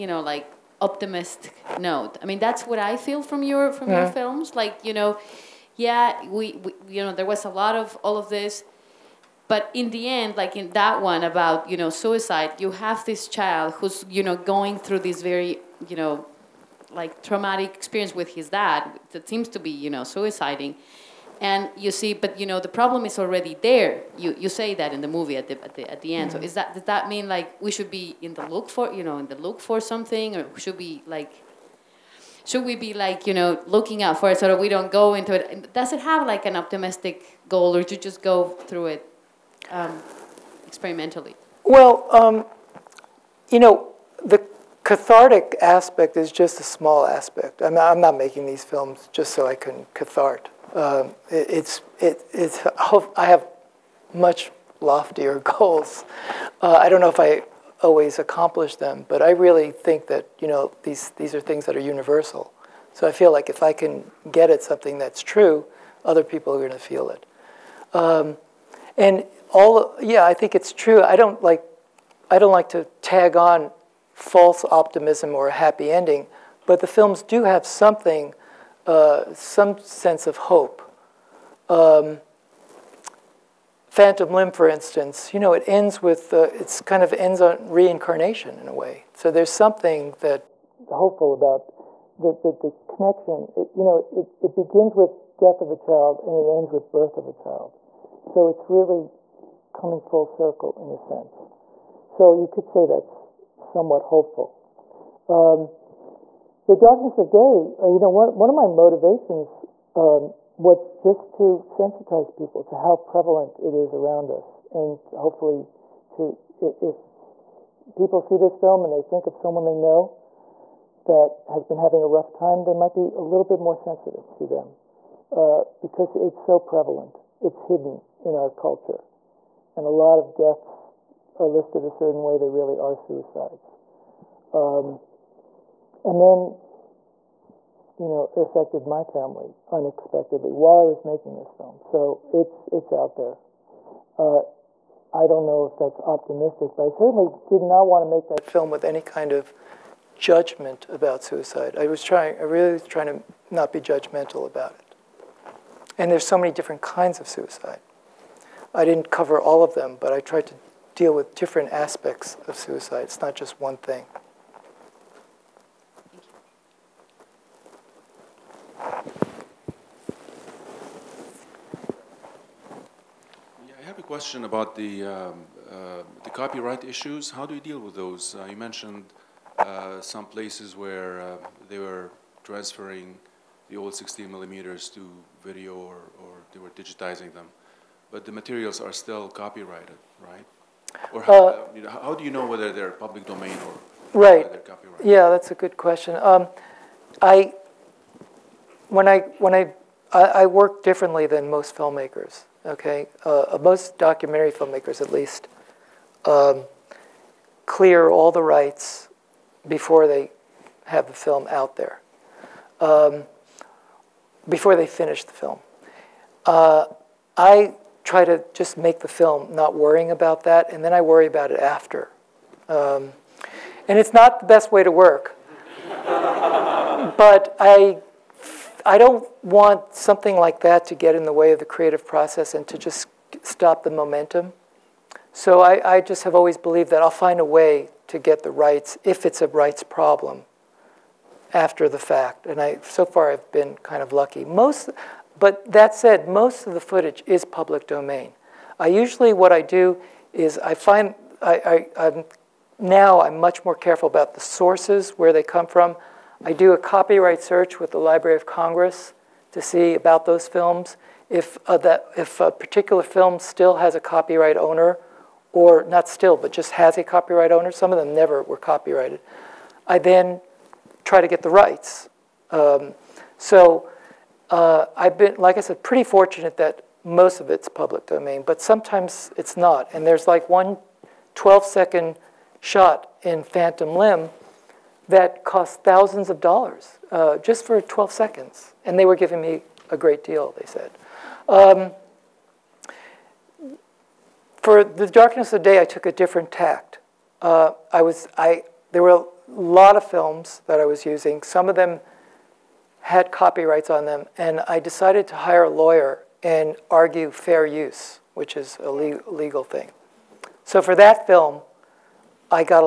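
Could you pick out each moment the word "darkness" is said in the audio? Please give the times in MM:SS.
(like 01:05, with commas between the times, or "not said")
01:46, 04:55.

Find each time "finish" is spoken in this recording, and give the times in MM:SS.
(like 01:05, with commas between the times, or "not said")
03:34.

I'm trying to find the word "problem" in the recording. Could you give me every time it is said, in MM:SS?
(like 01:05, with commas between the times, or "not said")
00:22, 03:59.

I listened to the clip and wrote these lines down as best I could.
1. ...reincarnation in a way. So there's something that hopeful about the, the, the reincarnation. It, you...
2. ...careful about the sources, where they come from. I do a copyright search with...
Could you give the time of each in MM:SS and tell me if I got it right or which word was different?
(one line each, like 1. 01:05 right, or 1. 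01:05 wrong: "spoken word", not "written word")
1. 01:27 wrong: "connection", not "reincarnation"
2. 04:13 right.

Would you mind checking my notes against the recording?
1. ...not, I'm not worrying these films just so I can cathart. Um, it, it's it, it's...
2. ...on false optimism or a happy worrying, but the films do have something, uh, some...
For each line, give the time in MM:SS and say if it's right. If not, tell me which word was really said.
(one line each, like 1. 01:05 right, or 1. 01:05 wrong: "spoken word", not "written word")
1. 00:47 wrong: "making", not "worrying"
2. 01:13 wrong: "ending", not "worrying".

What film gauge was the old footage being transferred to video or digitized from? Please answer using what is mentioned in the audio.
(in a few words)
16 millimeter.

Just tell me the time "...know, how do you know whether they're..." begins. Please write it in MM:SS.
03:11.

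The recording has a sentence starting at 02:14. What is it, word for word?
Um, and then you know, affected my family unexpectedly while I was making this film.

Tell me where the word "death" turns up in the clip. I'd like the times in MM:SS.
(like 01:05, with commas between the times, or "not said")
01:35, 02:10.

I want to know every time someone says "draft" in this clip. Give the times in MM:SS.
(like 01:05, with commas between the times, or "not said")
not said.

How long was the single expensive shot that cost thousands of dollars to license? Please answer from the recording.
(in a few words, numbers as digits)
12 seconds.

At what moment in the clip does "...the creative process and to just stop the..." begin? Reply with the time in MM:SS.
03:51.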